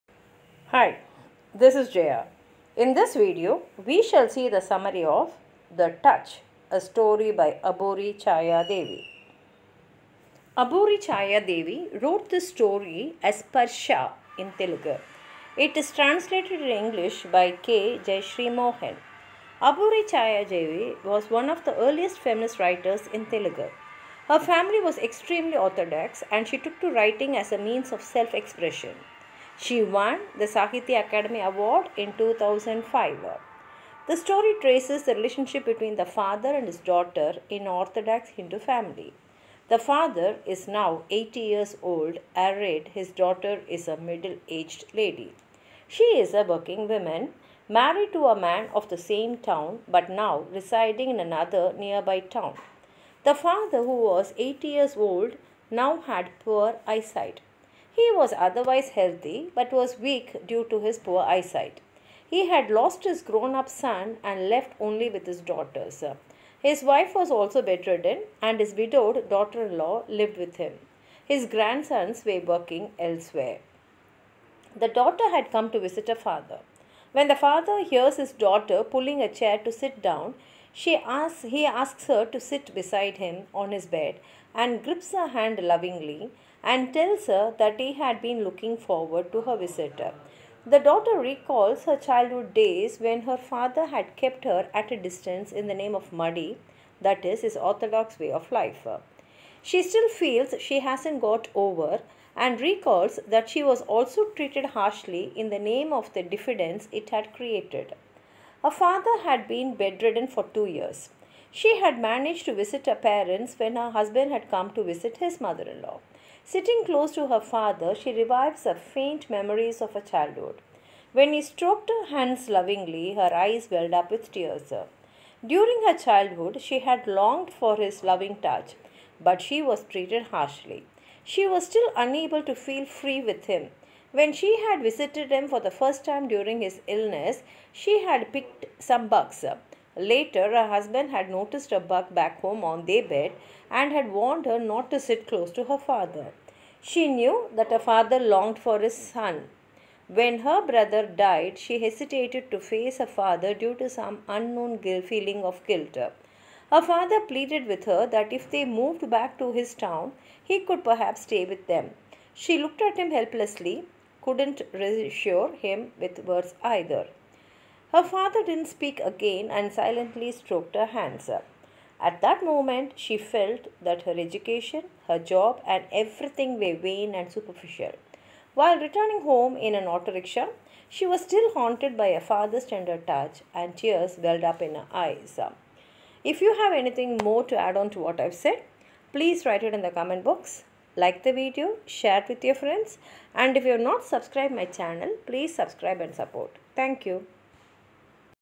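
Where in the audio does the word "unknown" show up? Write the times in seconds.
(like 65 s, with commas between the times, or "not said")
154 s.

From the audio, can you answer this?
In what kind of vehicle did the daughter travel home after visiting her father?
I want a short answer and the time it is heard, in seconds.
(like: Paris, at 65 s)
Auto rickshaw, at 179 s.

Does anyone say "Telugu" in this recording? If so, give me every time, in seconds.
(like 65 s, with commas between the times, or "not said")
14 s, 23 s.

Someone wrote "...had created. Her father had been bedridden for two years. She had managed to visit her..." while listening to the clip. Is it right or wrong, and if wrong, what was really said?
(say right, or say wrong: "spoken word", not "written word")
right.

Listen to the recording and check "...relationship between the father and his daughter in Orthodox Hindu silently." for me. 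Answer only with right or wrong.
wrong.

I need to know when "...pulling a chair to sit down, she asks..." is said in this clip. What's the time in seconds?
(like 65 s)
78 s.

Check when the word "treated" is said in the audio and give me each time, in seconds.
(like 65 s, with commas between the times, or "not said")
104 s, 129 s.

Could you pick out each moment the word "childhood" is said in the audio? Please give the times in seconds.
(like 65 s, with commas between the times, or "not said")
91 s, 120 s, 125 s.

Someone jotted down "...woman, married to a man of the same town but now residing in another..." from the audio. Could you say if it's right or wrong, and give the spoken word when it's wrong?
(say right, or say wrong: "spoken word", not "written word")
right.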